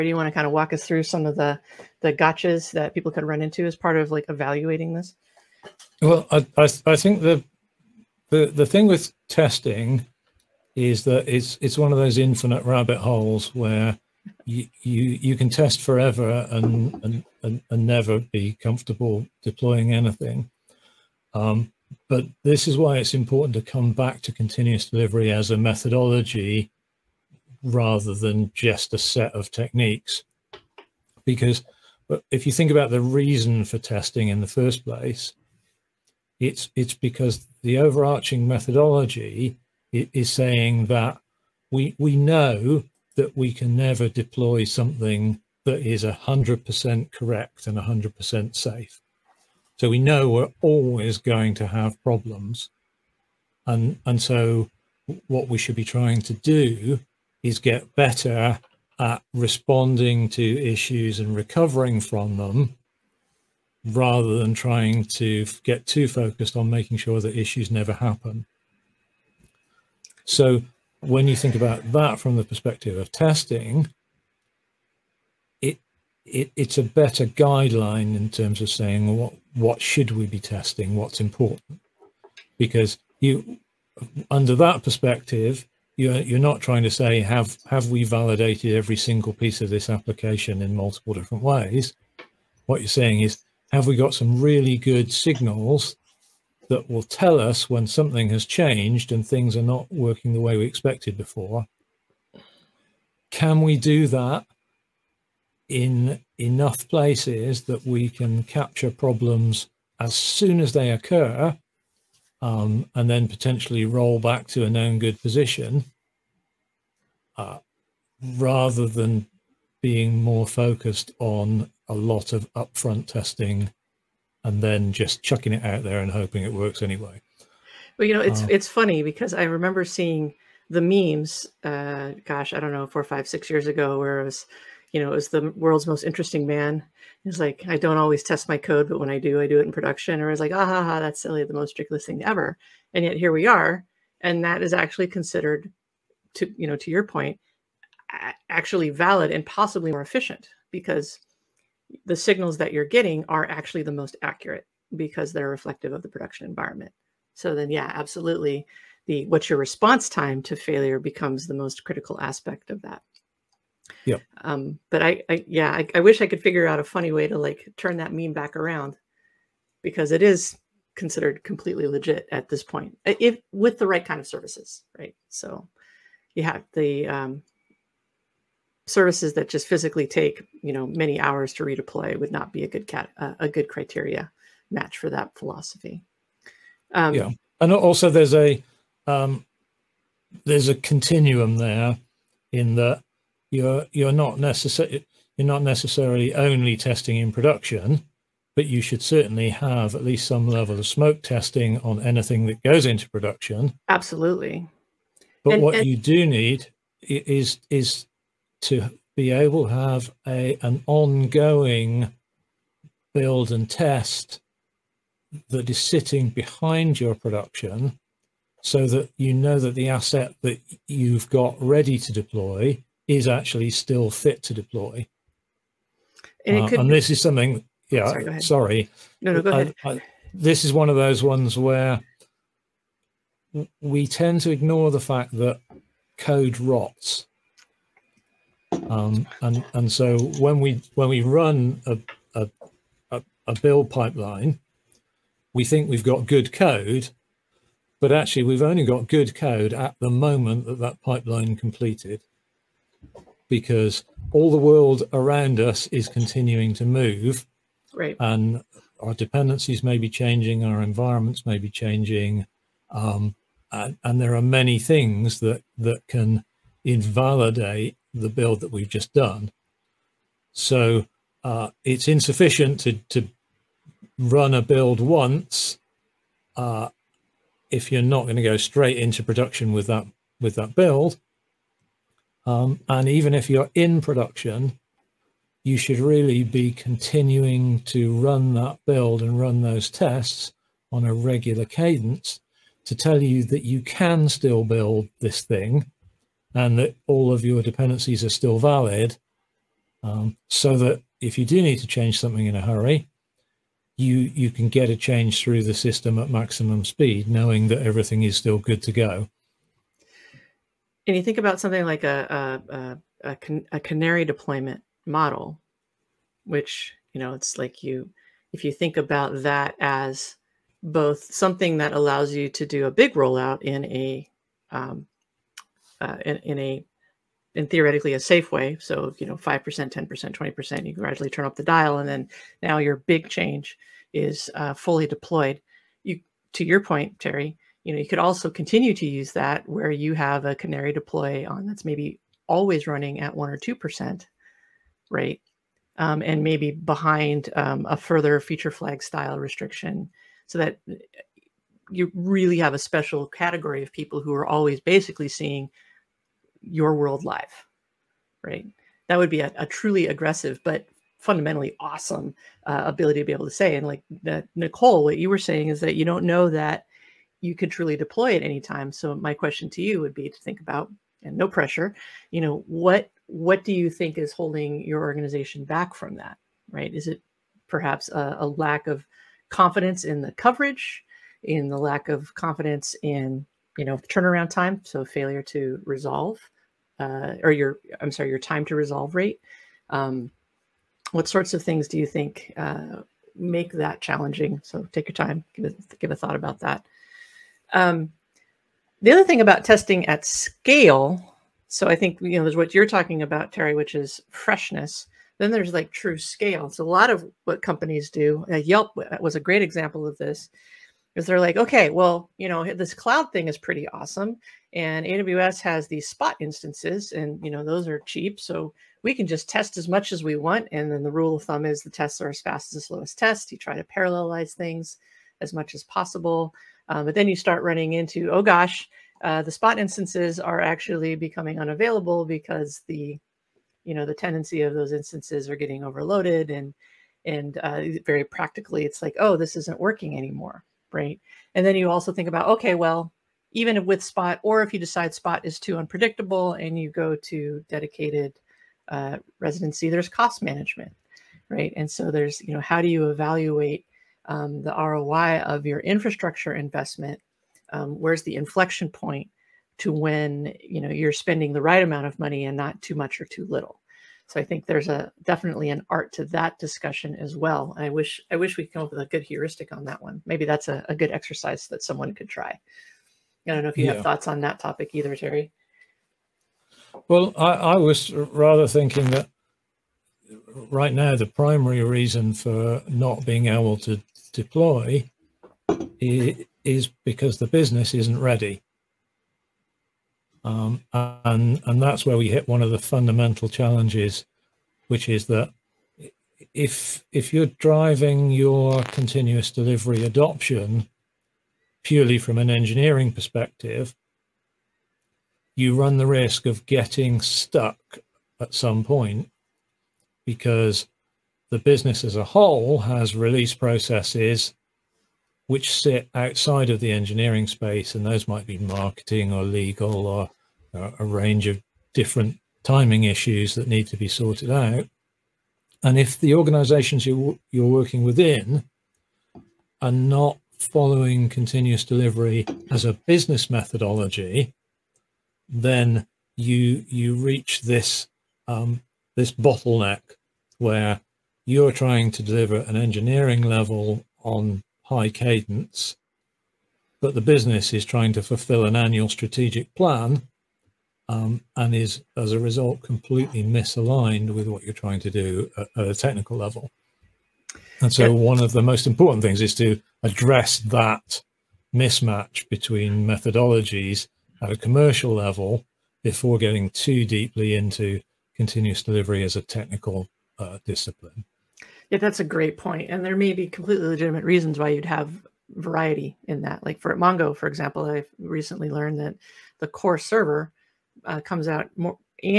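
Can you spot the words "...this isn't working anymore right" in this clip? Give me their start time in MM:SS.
07:19.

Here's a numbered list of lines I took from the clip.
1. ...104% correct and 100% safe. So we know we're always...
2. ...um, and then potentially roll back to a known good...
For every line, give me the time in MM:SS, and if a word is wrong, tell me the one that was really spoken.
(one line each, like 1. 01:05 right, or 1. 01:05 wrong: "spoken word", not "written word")
1. 00:46 wrong: "100", not "104"
2. 01:52 right.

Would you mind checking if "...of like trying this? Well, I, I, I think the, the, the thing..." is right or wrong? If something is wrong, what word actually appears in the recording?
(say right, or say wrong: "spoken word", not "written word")
wrong: "evaluating", not "trying".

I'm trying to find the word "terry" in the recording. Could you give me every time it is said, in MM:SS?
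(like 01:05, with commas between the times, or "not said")
05:37, 06:43, 07:55.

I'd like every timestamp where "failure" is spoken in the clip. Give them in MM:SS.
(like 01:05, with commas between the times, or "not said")
02:40, 06:25.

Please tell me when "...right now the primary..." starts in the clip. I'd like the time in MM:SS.
08:00.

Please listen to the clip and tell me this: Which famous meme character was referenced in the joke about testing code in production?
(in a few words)
The world's most interesting man.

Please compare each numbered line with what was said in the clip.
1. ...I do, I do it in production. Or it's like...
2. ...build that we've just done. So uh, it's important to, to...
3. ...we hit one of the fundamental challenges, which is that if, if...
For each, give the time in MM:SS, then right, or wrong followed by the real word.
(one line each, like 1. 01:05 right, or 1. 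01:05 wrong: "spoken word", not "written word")
1. 02:19 right
2. 04:28 wrong: "insufficient", not "important"
3. 08:12 right.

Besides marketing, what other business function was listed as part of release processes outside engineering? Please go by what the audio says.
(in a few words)
Legal.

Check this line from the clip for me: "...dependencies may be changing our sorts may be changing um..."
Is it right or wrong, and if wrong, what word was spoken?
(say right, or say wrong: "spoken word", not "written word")
wrong: "environments", not "sorts".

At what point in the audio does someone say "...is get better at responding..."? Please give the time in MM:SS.
00:57.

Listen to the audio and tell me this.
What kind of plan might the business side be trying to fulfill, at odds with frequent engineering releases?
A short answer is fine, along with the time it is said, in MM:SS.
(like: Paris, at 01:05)
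Annual strategic plan, at 09:08.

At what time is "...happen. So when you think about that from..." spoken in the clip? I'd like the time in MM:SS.
01:07.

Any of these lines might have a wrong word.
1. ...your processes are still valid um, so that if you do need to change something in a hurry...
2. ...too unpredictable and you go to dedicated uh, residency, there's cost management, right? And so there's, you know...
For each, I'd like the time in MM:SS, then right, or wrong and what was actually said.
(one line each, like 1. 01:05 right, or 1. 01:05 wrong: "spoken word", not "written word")
1. 04:57 wrong: "dependencies", not "processes"
2. 07:25 right.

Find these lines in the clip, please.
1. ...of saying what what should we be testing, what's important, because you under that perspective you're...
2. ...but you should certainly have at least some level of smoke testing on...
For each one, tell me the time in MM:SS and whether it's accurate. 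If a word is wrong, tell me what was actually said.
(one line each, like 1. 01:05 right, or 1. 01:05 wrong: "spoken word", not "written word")
1. 01:18 right
2. 03:18 right.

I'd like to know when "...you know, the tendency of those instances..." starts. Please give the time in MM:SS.
07:13.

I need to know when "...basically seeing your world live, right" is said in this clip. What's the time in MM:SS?
05:54.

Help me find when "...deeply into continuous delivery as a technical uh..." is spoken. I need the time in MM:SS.
09:27.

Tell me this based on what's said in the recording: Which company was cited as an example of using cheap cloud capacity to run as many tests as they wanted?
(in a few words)
Yelp.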